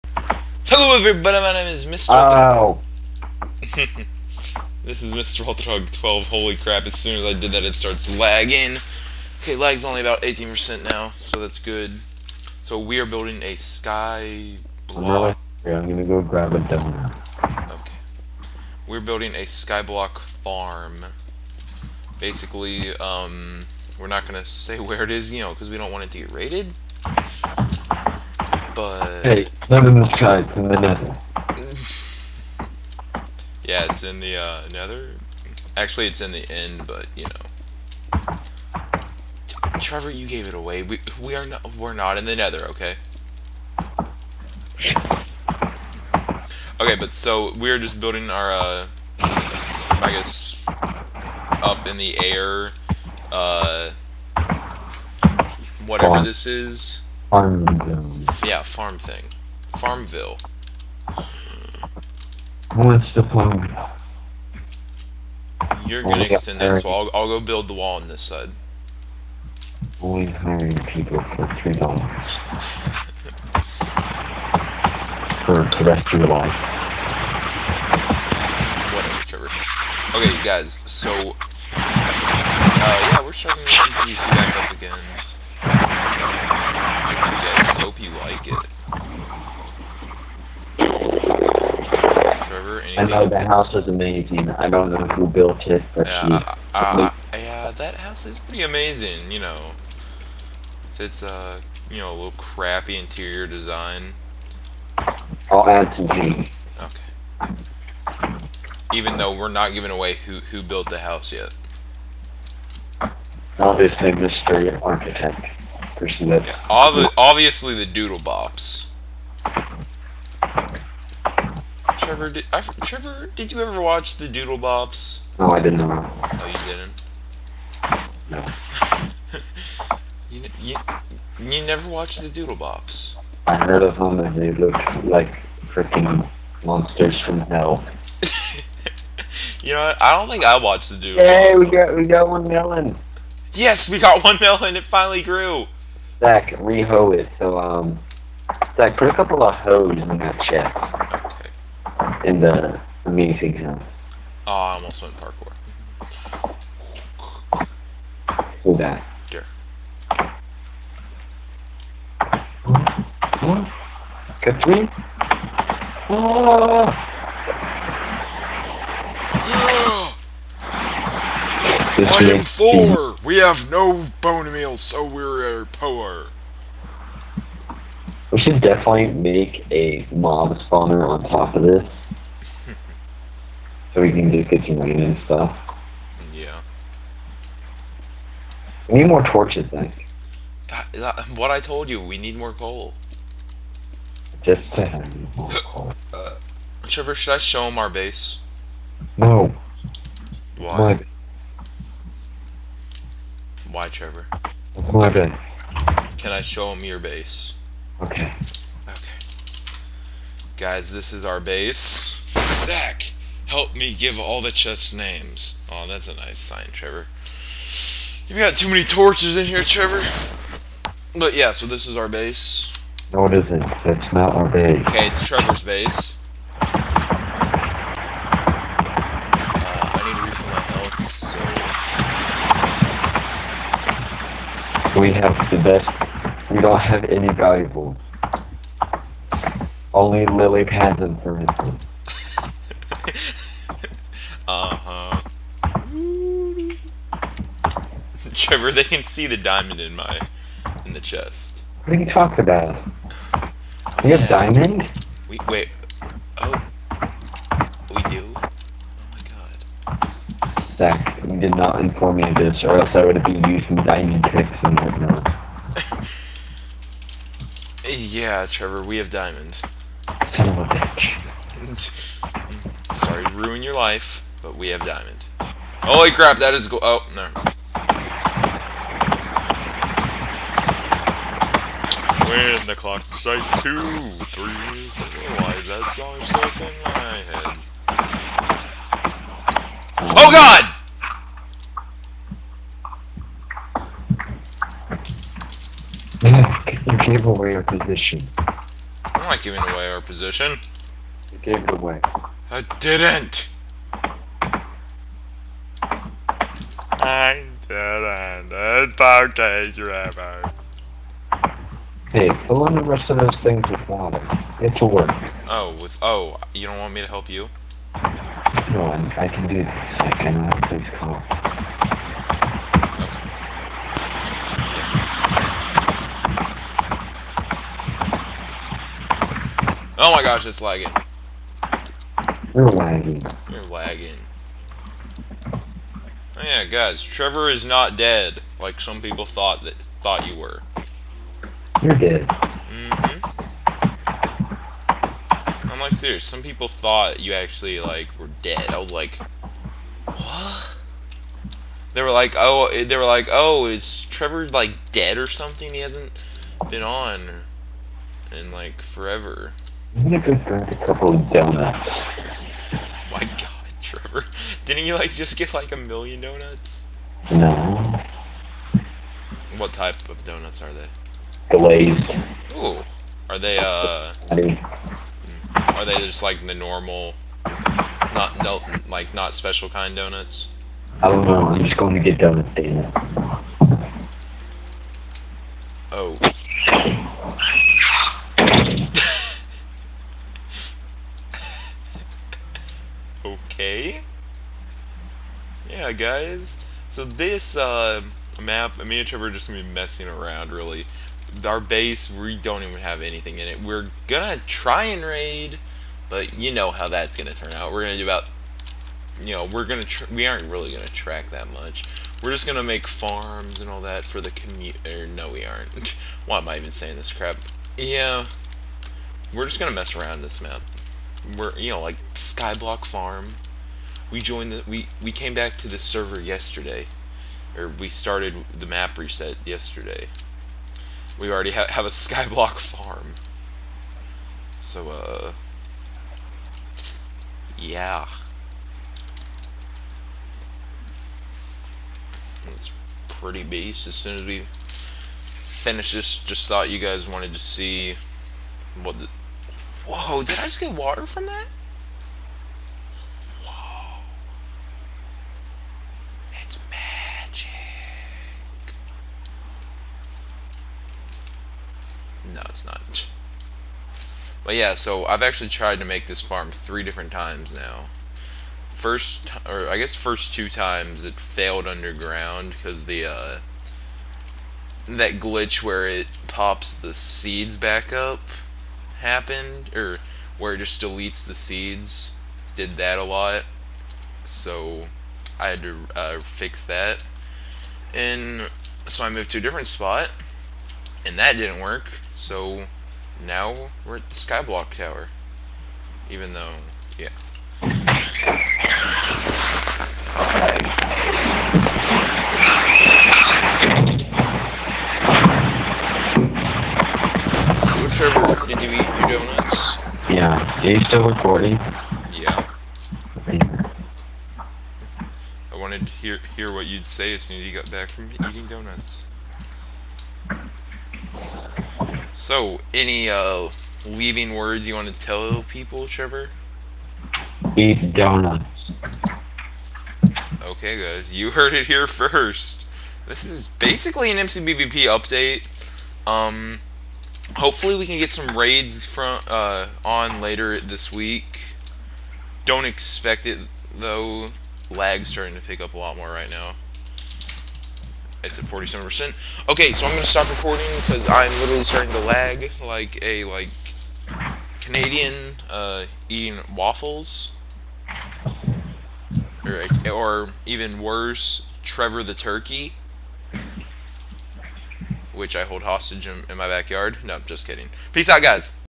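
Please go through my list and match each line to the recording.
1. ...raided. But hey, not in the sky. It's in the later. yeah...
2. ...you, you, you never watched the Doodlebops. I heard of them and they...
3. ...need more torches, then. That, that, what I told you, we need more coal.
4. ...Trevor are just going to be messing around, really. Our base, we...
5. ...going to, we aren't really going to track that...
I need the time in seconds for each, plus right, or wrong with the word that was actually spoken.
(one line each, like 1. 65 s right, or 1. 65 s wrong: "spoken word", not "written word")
1. 26 s wrong: "nether", not "later"
2. 130 s right
3. 189 s right
4. 399 s right
5. 409 s right.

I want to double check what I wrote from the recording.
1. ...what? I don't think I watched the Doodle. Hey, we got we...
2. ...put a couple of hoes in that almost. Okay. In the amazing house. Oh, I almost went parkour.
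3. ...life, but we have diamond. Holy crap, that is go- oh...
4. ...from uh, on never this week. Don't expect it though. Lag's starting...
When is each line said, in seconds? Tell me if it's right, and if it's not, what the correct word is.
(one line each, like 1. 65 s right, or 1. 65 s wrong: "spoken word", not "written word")
1. 139 s right
2. 148 s wrong: "chest", not "almost"
3. 273 s right
4. 538 s wrong: "later", not "never".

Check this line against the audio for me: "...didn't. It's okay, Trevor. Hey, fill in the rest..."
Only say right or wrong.
right.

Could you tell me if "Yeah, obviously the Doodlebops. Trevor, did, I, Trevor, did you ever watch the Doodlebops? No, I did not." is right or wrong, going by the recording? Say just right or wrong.
right.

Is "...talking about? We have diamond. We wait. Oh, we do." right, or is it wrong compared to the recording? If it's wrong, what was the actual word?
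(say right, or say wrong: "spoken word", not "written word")
right.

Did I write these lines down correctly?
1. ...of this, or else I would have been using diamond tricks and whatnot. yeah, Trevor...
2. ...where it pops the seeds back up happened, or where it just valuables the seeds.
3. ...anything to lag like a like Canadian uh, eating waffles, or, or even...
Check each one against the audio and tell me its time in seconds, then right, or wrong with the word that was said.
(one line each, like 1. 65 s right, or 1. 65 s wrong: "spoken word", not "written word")
1. 262 s right
2. 475 s wrong: "deletes", not "valuables"
3. 551 s wrong: "starting", not "anything".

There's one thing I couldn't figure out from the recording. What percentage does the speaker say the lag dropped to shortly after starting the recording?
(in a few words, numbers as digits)
18%.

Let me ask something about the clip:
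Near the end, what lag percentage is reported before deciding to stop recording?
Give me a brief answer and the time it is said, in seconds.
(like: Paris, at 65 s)
47%, at 548 s.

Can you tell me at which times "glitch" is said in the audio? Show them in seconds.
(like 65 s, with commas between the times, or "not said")
475 s.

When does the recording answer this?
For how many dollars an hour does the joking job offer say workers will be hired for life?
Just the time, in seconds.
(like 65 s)
71 s.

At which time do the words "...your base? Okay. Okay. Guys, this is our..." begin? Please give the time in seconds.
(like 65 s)
206 s.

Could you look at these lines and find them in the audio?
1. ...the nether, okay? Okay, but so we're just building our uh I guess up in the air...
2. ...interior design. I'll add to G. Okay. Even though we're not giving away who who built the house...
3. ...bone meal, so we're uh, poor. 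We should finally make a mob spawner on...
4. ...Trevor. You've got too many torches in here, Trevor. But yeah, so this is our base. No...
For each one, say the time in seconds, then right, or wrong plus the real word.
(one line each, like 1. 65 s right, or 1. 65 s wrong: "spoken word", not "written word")
1. 42 s right
2. 102 s right
3. 174 s wrong: "definitely", not "finally"
4. 216 s right.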